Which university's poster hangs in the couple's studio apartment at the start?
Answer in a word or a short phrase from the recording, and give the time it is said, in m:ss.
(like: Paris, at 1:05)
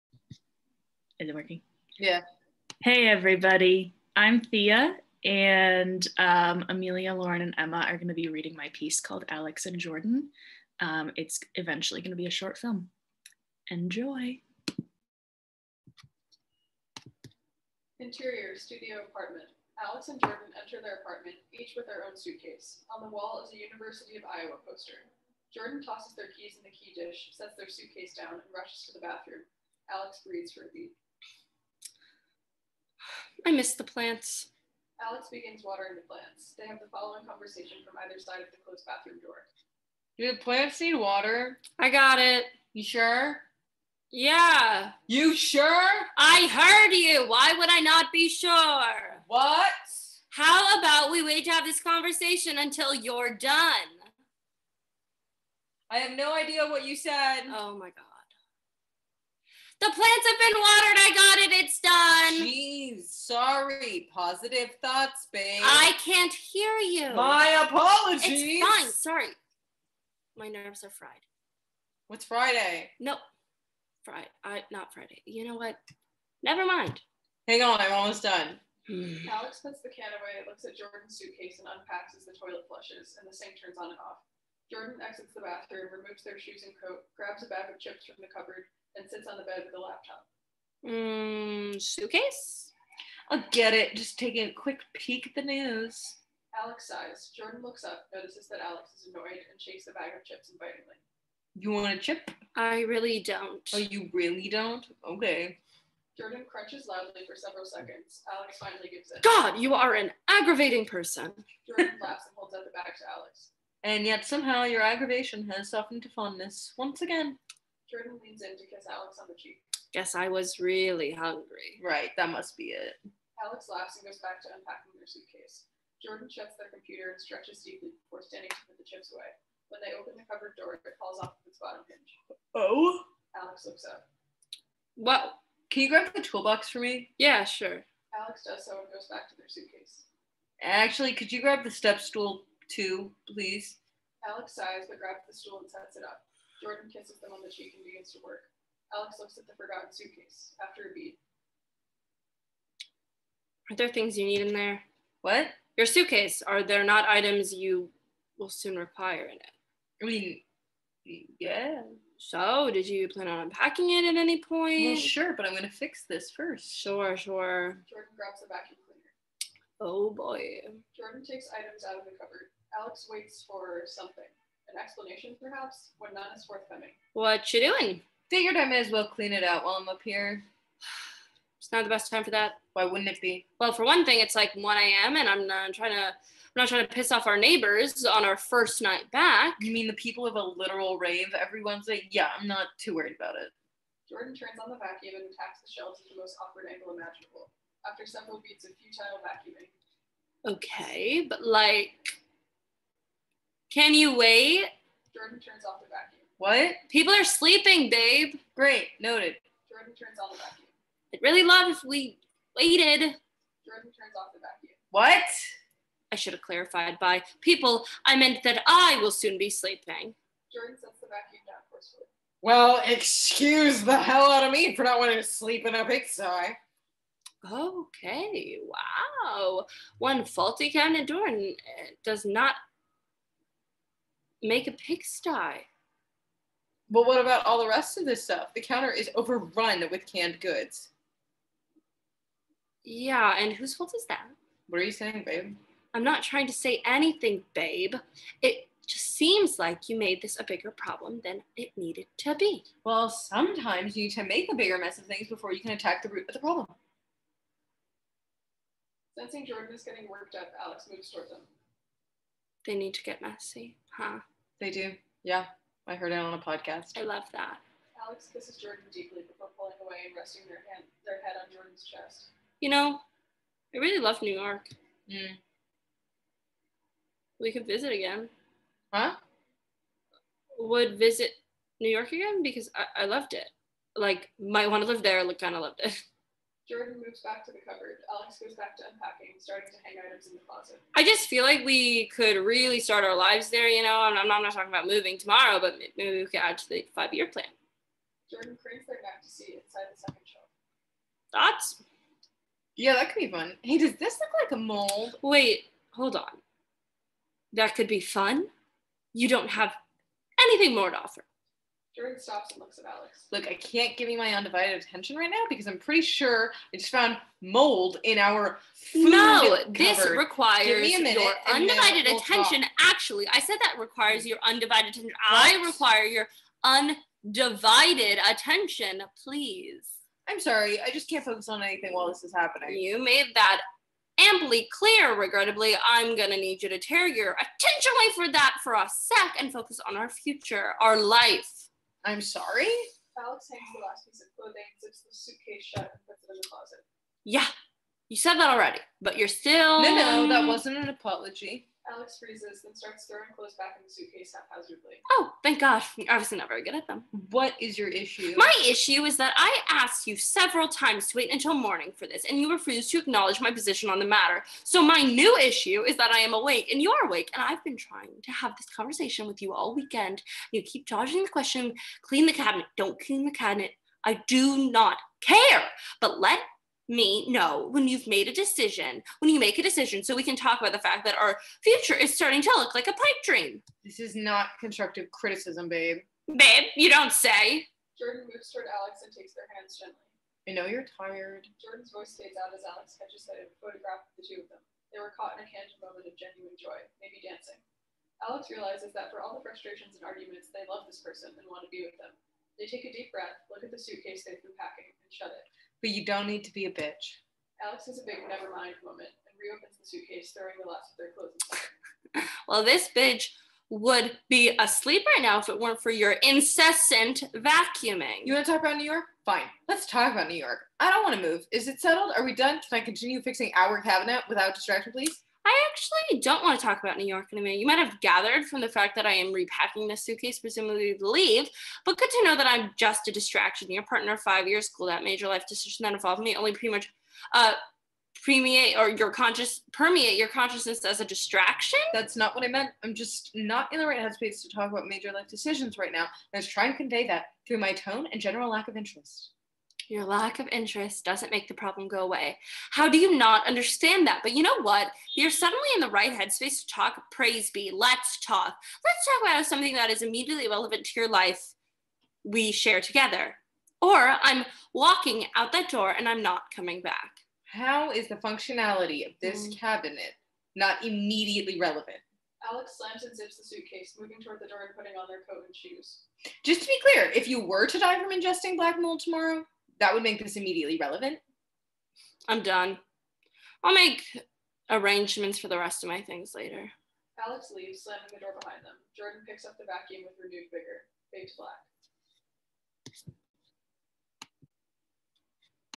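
University of Iowa, at 0:23.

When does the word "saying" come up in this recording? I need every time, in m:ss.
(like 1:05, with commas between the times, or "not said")
4:04.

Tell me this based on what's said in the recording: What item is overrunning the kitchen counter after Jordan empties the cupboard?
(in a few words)
Canned goods.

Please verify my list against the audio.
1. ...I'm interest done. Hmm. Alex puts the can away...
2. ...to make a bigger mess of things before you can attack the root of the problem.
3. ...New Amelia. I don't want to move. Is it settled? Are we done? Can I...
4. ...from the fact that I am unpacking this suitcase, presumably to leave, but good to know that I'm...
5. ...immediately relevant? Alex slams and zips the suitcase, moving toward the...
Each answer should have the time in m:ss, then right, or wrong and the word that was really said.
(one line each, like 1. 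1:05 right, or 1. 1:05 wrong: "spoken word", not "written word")
1. 1:17 wrong: "almost", not "interest"
2. 4:14 right
3. 7:00 wrong: "York", not "Amelia"
4. 7:08 wrong: "repacking", not "unpacking"
5. 7:50 right.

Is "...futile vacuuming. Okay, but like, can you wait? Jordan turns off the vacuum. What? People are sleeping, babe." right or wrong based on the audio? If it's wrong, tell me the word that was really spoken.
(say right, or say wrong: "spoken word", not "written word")
right.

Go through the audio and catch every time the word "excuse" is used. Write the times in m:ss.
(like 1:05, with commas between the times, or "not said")
3:42.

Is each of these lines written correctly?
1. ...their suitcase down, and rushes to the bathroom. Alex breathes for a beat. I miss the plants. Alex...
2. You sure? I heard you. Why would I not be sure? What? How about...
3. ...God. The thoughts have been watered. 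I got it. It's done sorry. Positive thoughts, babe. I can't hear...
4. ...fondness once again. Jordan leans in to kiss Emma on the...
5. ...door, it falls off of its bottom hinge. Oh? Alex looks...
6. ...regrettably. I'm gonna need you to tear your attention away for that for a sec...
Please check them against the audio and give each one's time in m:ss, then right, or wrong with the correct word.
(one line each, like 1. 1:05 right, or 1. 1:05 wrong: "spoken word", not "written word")
1. 0:27 right
2. 0:45 right
3. 0:57 wrong: "plants", not "thoughts"
4. 1:56 wrong: "Alex", not "Emma"
5. 2:10 right
6. 5:35 right.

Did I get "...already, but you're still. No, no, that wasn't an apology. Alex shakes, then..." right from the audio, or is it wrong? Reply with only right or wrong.
wrong.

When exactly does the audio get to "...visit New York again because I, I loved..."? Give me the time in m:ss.
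4:40.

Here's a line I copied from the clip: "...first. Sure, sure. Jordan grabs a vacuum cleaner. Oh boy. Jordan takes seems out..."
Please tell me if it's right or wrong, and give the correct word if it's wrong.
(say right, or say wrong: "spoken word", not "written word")
wrong: "items", not "seems".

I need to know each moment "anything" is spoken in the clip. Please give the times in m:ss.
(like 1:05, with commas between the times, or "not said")
4:06, 5:10, 5:31.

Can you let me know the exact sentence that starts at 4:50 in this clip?
I just feel like we could really start our lives there, you know.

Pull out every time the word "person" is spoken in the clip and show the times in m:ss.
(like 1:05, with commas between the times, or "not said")
1:50, 6:40.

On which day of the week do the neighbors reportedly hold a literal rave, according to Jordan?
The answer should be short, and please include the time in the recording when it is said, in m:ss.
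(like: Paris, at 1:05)
Wednesday, at 3:11.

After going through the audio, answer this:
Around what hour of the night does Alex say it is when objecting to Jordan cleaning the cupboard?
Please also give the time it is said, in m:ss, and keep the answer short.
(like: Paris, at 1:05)
1 a.m., at 3:04.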